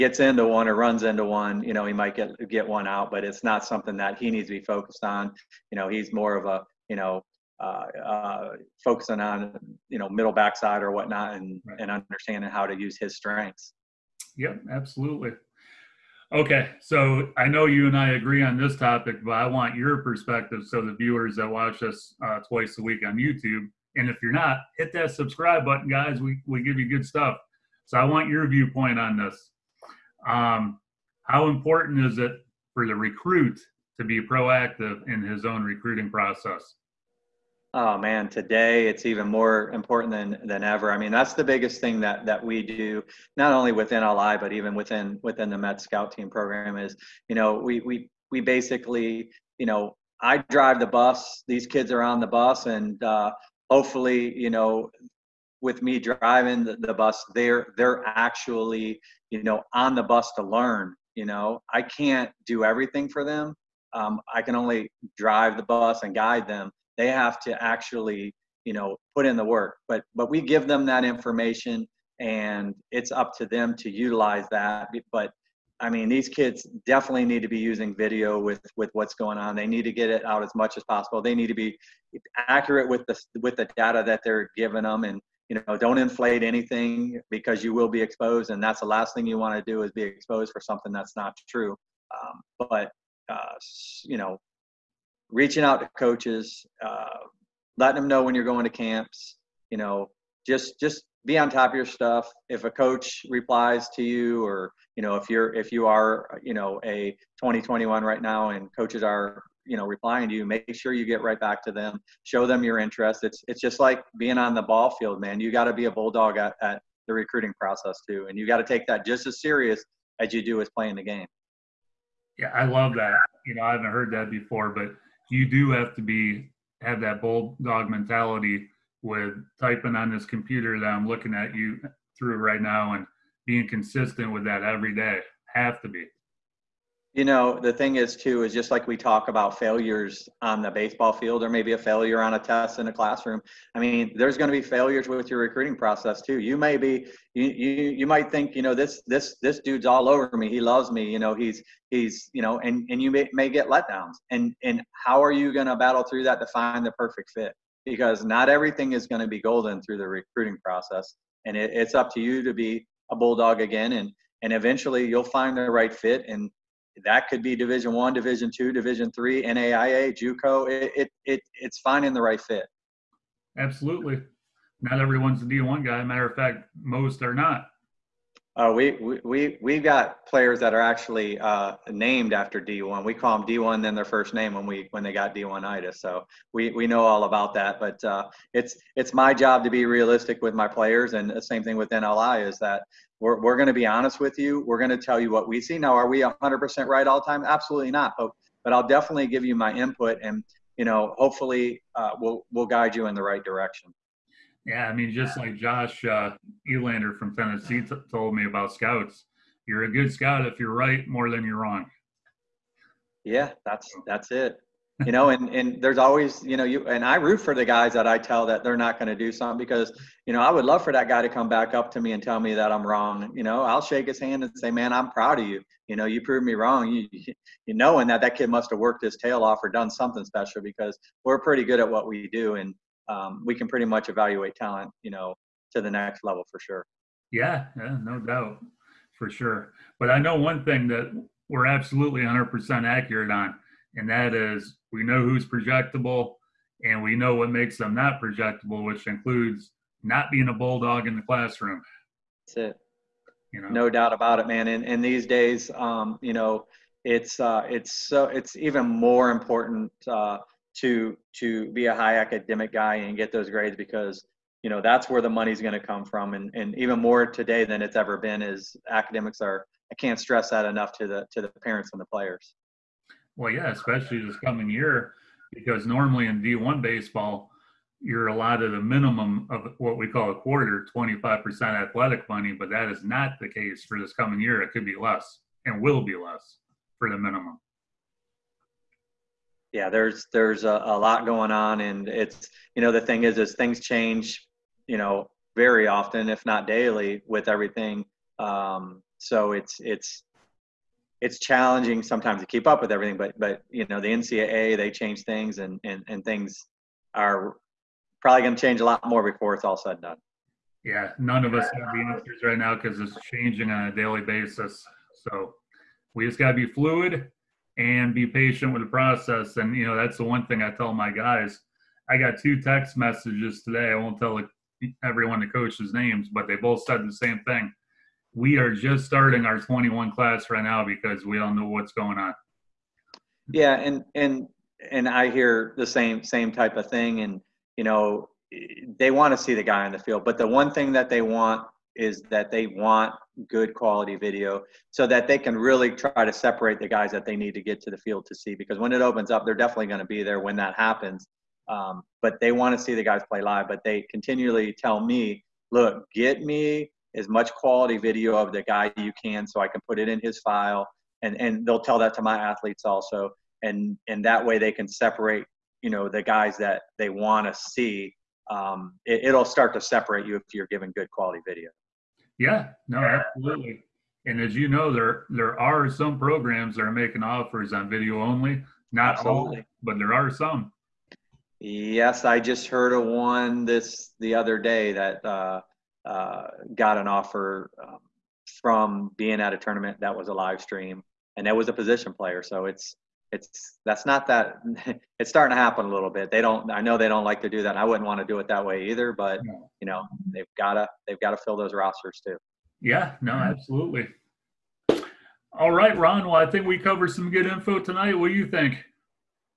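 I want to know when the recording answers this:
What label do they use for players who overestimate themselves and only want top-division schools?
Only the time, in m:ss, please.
3:05.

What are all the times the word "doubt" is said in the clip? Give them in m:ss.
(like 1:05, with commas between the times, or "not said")
3:58, 4:13.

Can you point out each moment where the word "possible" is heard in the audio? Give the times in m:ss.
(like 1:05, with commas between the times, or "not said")
1:20.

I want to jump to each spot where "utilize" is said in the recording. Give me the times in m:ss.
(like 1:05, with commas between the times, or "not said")
1:13.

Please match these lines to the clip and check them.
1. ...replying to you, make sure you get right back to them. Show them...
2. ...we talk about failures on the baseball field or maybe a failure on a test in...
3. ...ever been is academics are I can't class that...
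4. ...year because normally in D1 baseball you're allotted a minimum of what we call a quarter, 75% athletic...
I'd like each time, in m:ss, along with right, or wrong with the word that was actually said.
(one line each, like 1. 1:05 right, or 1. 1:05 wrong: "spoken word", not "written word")
1. 1:49 right
2. 2:18 right
3. 4:27 wrong: "stress", not "class"
4. 4:34 wrong: "25", not "75".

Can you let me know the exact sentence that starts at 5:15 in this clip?
So we just got to be fluid and be patient with the process.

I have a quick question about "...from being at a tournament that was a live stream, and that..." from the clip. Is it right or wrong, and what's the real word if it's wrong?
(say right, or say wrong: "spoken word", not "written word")
right.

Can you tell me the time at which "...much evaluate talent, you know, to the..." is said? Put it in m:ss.
3:53.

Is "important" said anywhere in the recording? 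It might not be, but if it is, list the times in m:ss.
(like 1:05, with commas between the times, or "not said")
0:31, 0:39, 4:19.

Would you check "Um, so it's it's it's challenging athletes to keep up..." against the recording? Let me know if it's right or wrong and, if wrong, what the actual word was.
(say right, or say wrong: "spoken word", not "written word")
wrong: "sometimes", not "athletes".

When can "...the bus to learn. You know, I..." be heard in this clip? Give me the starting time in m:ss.
0:59.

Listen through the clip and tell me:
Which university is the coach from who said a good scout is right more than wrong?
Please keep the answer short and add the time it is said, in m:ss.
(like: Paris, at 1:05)
Tennessee, at 3:27.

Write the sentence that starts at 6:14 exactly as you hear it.
And as you know, there there are some programs that are making offers on video only.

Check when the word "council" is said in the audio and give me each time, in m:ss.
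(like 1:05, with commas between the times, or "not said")
not said.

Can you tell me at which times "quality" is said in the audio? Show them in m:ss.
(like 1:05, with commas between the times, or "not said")
5:43, 5:57, 6:11.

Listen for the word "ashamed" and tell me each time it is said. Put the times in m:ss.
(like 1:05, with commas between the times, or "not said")
not said.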